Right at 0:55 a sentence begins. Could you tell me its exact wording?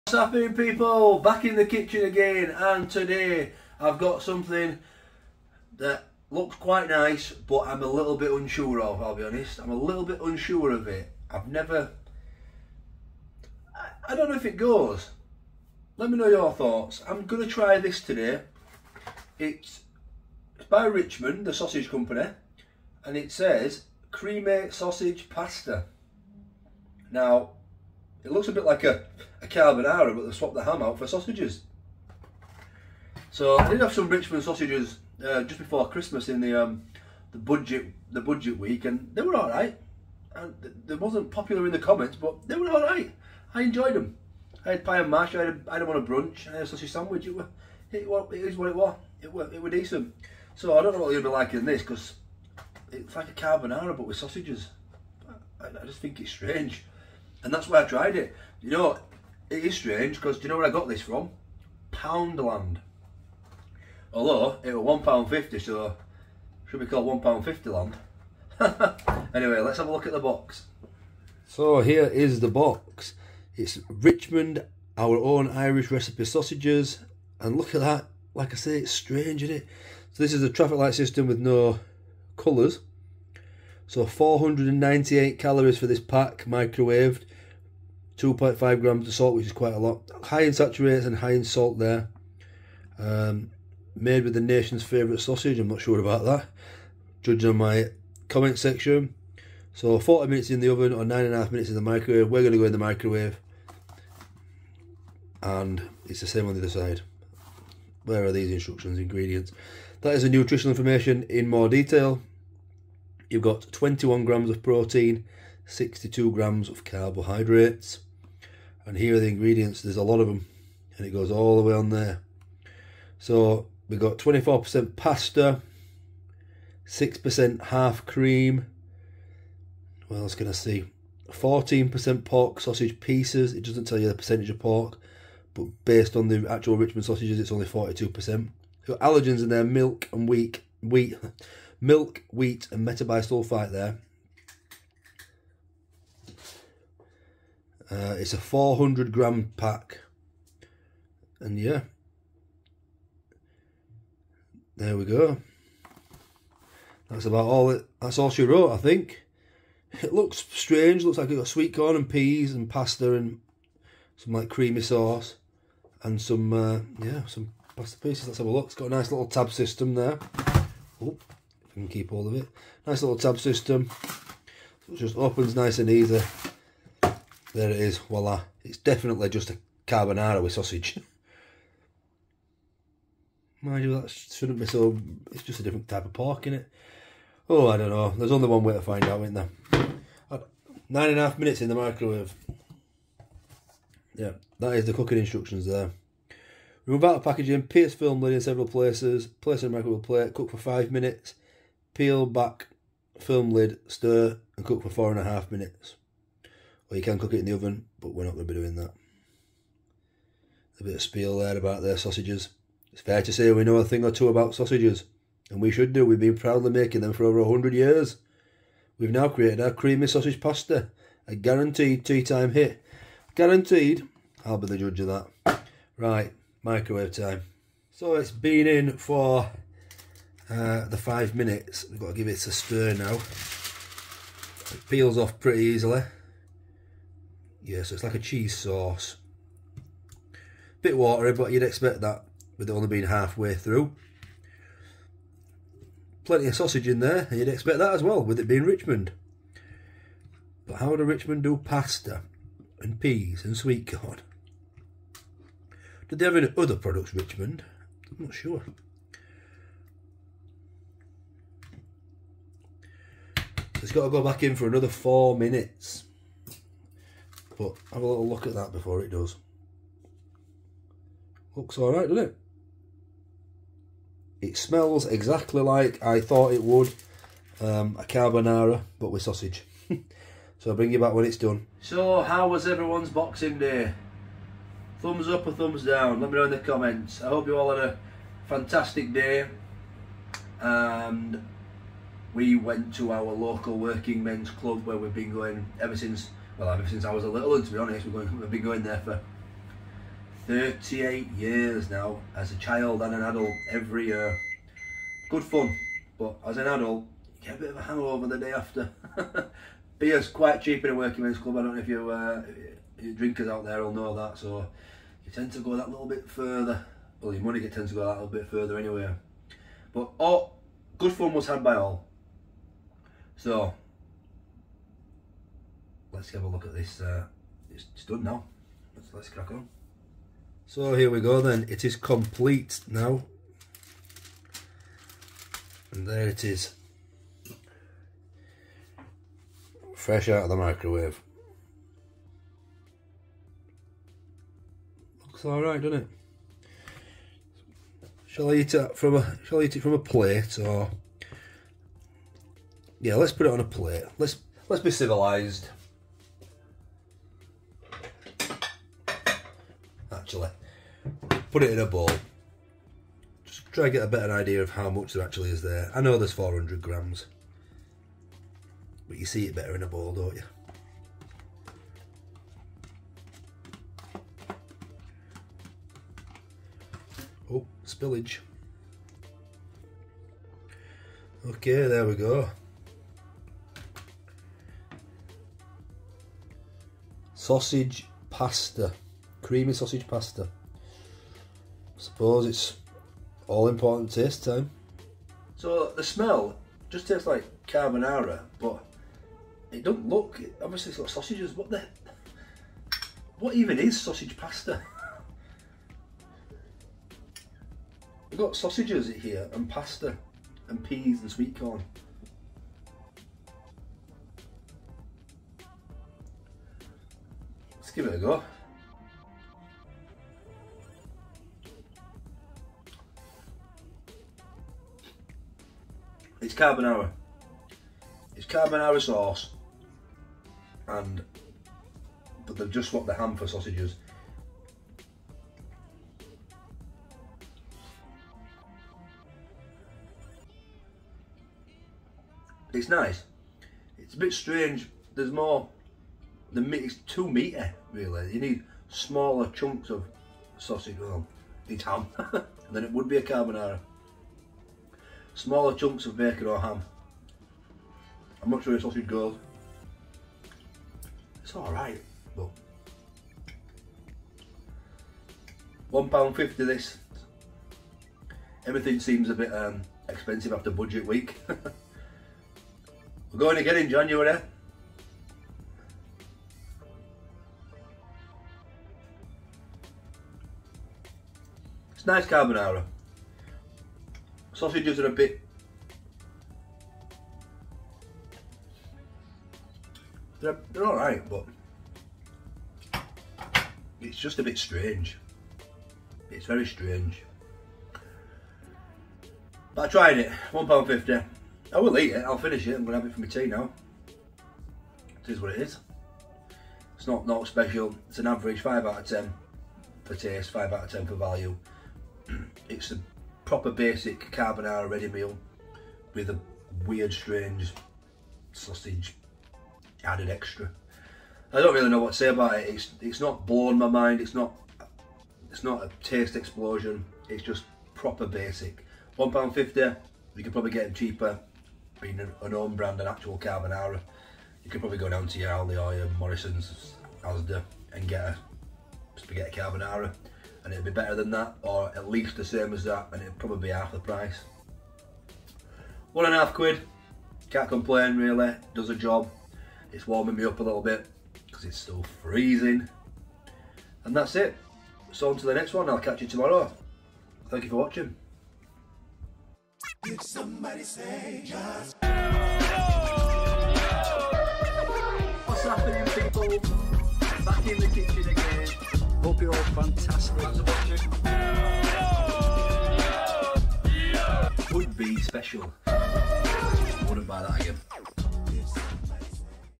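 I, I just think it's strange.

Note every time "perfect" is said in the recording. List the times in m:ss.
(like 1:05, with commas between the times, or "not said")
not said.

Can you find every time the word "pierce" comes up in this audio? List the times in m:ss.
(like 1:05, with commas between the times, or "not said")
3:17.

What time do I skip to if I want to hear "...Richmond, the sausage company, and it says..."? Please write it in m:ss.
0:20.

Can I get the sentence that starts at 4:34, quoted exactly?
It smells exactly like I thought it would.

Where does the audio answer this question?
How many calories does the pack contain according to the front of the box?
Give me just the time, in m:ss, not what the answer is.
1:24.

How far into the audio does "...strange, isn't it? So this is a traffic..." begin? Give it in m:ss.
1:18.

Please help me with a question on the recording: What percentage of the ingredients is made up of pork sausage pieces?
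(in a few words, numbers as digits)
14%.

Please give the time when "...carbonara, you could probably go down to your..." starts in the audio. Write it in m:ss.
8:53.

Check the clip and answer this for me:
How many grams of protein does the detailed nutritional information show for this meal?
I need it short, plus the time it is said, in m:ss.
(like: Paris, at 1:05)
21 grams, at 1:53.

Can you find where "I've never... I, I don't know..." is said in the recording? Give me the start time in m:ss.
0:11.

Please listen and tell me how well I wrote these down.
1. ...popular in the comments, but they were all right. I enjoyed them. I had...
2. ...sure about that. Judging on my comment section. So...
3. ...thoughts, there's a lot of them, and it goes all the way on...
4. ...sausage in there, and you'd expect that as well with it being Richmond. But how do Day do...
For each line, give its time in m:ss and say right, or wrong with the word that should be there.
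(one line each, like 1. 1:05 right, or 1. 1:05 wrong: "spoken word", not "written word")
1. 0:41 right
2. 1:35 right
3. 1:59 wrong: "ingredients", not "thoughts"
4. 4:06 wrong: "Richmond", not "Day".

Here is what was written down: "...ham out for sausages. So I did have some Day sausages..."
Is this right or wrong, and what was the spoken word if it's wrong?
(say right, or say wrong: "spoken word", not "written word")
wrong: "Richmond", not "Day".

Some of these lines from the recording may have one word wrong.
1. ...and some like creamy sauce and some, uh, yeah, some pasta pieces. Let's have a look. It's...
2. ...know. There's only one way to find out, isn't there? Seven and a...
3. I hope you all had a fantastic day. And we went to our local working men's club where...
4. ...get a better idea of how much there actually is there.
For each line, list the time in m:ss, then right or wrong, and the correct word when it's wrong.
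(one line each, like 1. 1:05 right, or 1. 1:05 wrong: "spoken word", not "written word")
1. 2:43 right
2. 3:07 wrong: "Nine", not "Seven"
3. 4:47 right
4. 6:03 right.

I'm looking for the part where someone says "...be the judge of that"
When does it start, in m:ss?
3:44.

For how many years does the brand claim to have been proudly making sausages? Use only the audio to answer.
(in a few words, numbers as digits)
over a hundred years.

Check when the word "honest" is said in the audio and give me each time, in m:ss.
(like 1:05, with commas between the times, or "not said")
0:09, 4:57.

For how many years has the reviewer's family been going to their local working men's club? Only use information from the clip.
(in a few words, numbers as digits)
38 years.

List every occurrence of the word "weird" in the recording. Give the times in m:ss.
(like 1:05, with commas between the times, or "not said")
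8:36.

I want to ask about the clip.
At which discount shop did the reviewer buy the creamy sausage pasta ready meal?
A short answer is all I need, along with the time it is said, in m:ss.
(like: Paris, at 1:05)
Poundland, at 1:01.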